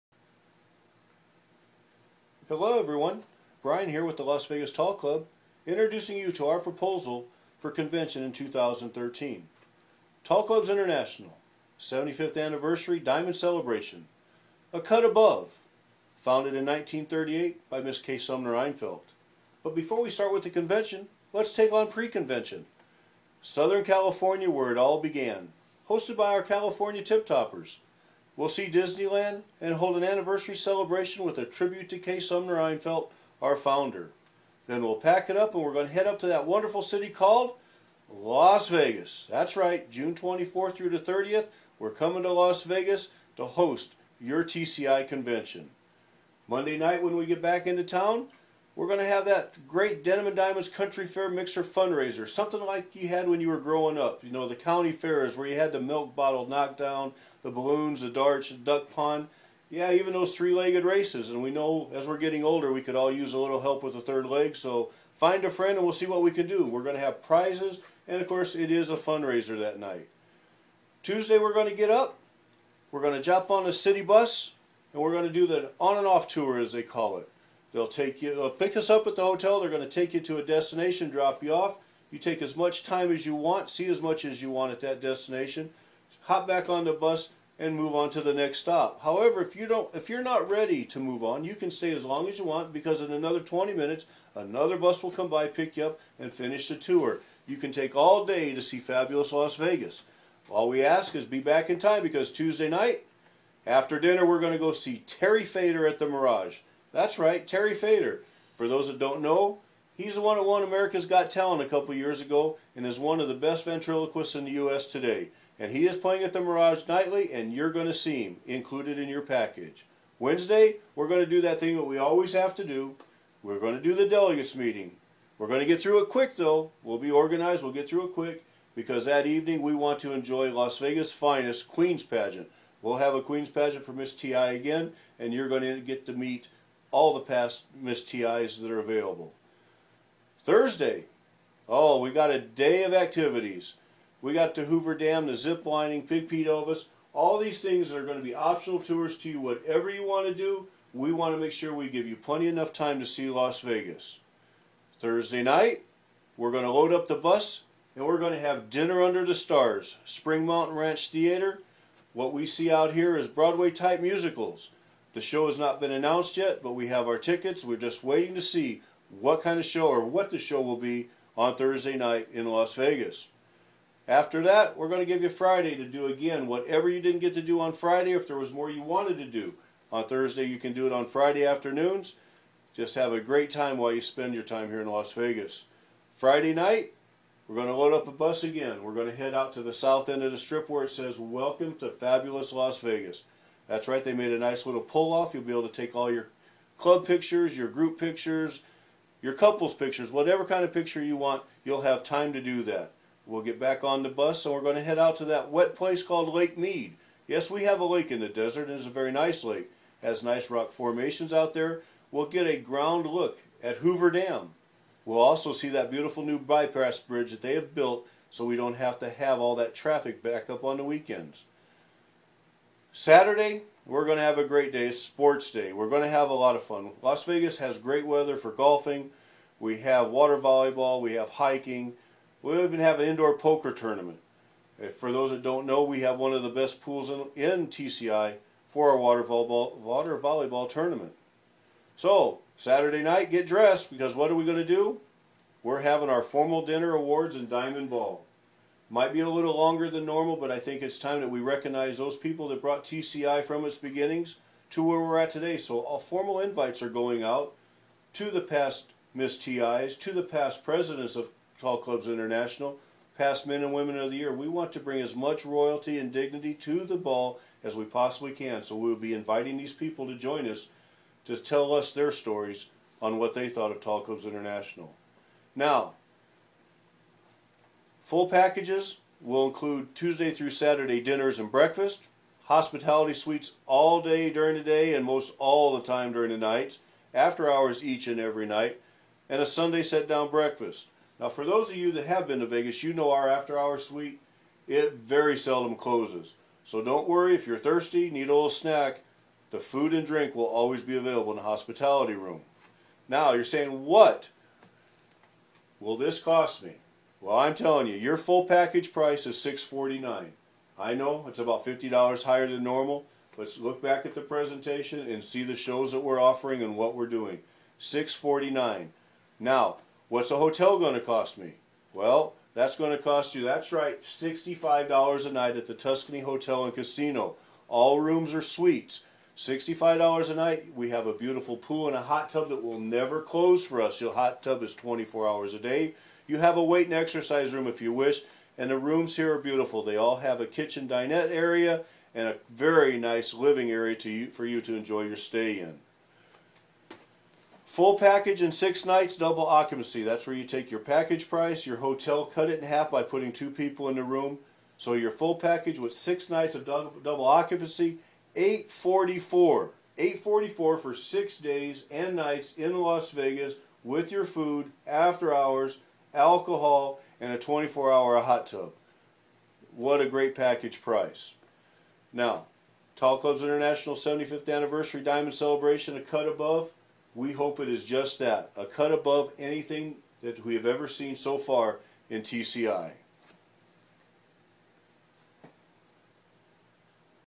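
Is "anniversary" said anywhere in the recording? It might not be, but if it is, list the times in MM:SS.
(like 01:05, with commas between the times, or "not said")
00:12, 00:30, 06:14.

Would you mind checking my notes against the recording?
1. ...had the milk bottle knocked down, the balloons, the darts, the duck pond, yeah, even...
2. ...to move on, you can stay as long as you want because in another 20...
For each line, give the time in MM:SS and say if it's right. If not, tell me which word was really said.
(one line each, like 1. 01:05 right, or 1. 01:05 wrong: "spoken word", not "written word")
1. 00:55 right
2. 01:30 right.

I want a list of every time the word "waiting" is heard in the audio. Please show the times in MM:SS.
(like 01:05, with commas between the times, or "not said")
02:48.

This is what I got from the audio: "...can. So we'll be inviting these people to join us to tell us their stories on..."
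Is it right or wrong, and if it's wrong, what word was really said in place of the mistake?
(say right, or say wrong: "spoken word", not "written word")
right.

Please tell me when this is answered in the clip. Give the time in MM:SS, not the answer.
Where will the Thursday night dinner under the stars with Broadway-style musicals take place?
02:40.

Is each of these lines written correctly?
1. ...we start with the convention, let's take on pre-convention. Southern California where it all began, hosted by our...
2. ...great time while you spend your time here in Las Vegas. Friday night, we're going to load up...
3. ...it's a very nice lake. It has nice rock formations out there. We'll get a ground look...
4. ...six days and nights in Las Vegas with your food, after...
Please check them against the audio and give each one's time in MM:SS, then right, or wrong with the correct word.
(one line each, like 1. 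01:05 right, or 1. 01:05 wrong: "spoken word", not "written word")
1. 00:20 right
2. 03:03 right
3. 03:28 right
4. 06:00 right.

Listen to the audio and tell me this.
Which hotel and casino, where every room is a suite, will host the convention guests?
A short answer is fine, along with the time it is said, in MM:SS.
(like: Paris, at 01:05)
Tuscany Hotel and Casino, at 05:25.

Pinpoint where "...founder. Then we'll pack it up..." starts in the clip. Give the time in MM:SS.
00:33.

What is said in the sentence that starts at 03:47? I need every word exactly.
Las Vegas has great weather for golfing.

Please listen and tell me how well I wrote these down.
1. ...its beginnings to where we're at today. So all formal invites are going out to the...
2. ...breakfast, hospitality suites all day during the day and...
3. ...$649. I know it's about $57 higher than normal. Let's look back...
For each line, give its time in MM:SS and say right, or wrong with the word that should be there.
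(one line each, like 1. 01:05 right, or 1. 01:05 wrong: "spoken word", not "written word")
1. 04:13 right
2. 04:41 right
3. 05:09 wrong: "50", not "57".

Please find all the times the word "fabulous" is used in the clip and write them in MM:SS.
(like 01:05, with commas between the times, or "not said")
01:38, 03:11.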